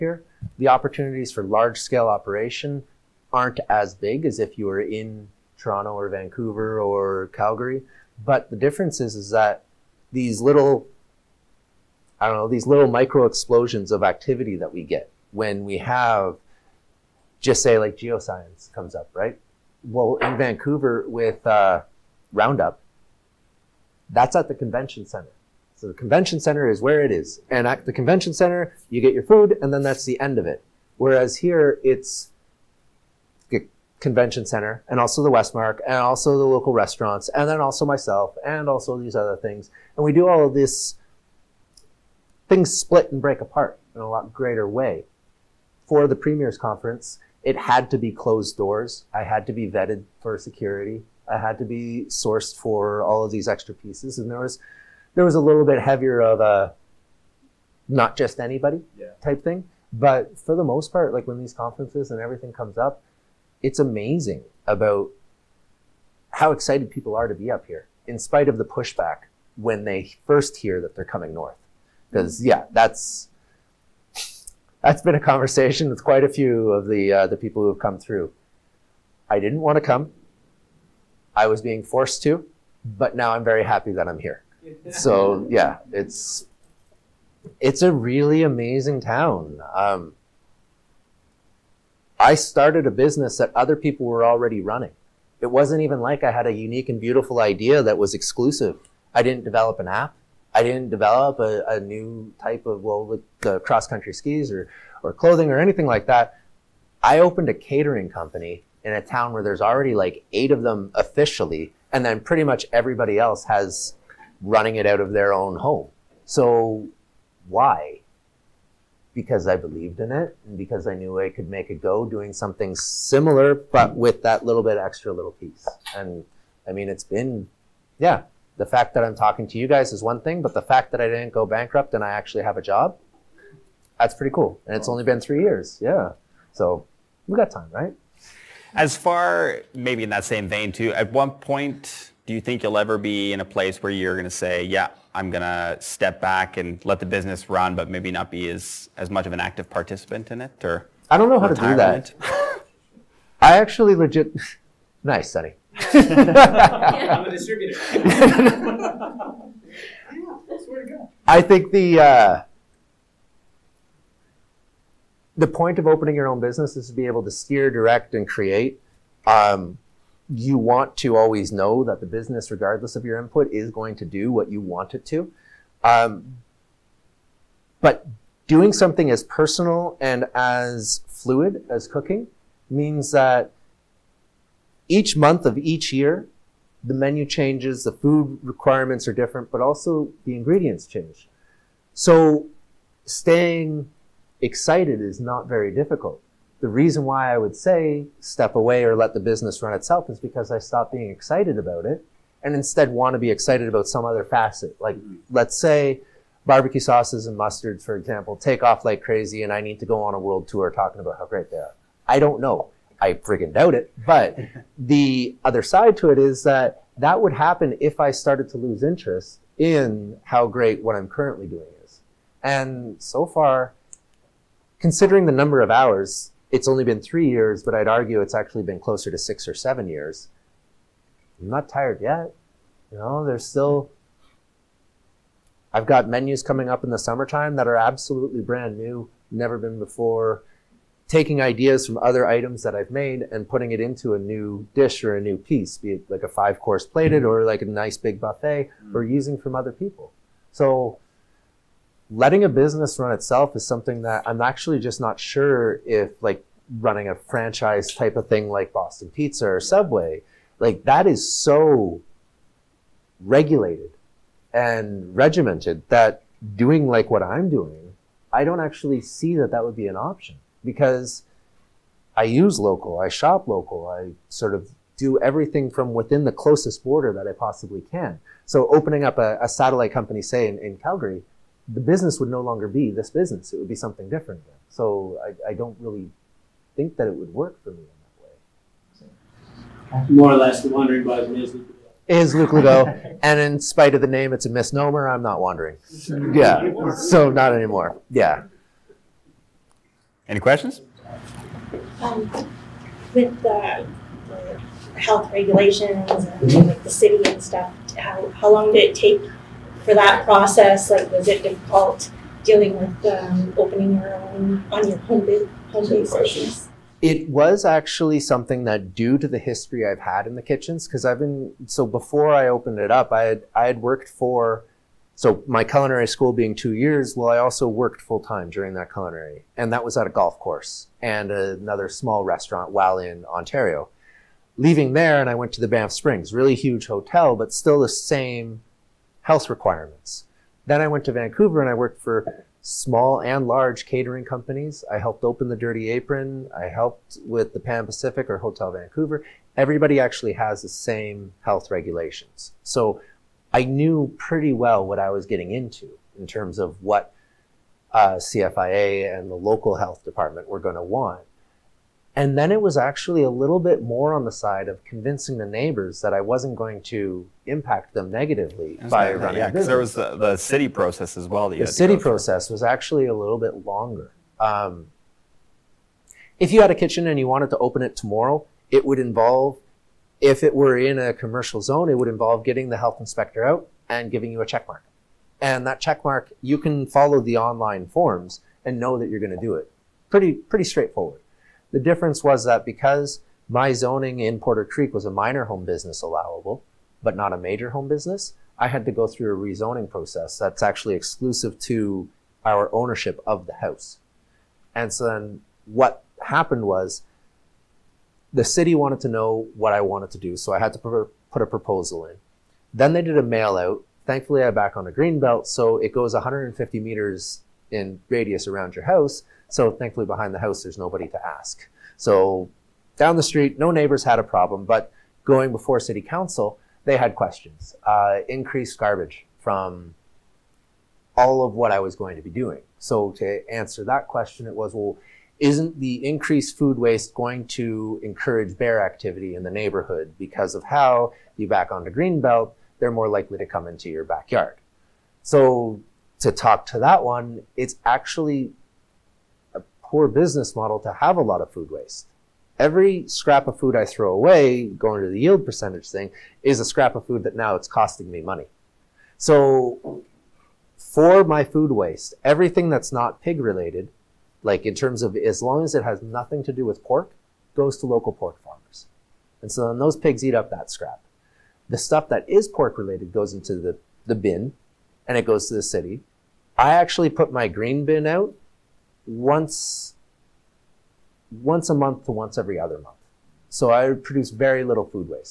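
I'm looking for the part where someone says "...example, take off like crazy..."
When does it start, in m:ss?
3:27.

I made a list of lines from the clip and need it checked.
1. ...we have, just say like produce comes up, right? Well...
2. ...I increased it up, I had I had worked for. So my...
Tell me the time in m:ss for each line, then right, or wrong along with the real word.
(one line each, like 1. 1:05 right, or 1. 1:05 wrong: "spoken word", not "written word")
1. 0:15 wrong: "geoscience", not "produce"
2. 5:22 wrong: "opened", not "increased".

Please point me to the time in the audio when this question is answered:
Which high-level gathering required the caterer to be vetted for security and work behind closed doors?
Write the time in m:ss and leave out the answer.
0:46.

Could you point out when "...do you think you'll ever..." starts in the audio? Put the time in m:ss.
2:22.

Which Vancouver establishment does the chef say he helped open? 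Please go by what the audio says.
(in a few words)
the Dirty Apron.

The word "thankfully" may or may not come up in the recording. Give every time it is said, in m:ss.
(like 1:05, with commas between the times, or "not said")
6:54, 6:59.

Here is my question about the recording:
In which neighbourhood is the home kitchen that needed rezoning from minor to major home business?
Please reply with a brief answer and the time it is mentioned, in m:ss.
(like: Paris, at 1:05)
Porter Creek, at 6:34.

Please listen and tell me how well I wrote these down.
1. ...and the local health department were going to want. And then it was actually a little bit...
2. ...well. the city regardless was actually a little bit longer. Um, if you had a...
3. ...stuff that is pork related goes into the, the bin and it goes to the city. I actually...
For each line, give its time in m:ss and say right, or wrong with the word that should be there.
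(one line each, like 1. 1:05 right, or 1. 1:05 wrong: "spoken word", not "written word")
1. 5:59 right
2. 6:11 wrong: "process", not "regardless"
3. 7:51 right.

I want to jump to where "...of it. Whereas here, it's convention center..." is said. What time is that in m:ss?
0:30.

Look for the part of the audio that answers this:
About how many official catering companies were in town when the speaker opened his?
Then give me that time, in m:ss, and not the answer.
1:50.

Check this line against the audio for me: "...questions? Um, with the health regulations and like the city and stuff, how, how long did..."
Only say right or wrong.
right.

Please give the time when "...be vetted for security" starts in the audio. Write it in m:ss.
0:49.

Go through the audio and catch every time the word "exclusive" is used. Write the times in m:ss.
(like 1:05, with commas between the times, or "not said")
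1:38, 6:40.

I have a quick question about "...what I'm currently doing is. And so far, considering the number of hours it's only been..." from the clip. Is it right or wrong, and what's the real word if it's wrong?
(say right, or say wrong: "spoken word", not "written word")
right.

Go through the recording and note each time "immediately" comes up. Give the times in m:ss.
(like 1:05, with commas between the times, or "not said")
not said.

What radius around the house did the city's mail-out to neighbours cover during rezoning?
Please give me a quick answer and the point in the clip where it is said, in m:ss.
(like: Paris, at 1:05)
150 meters, at 6:56.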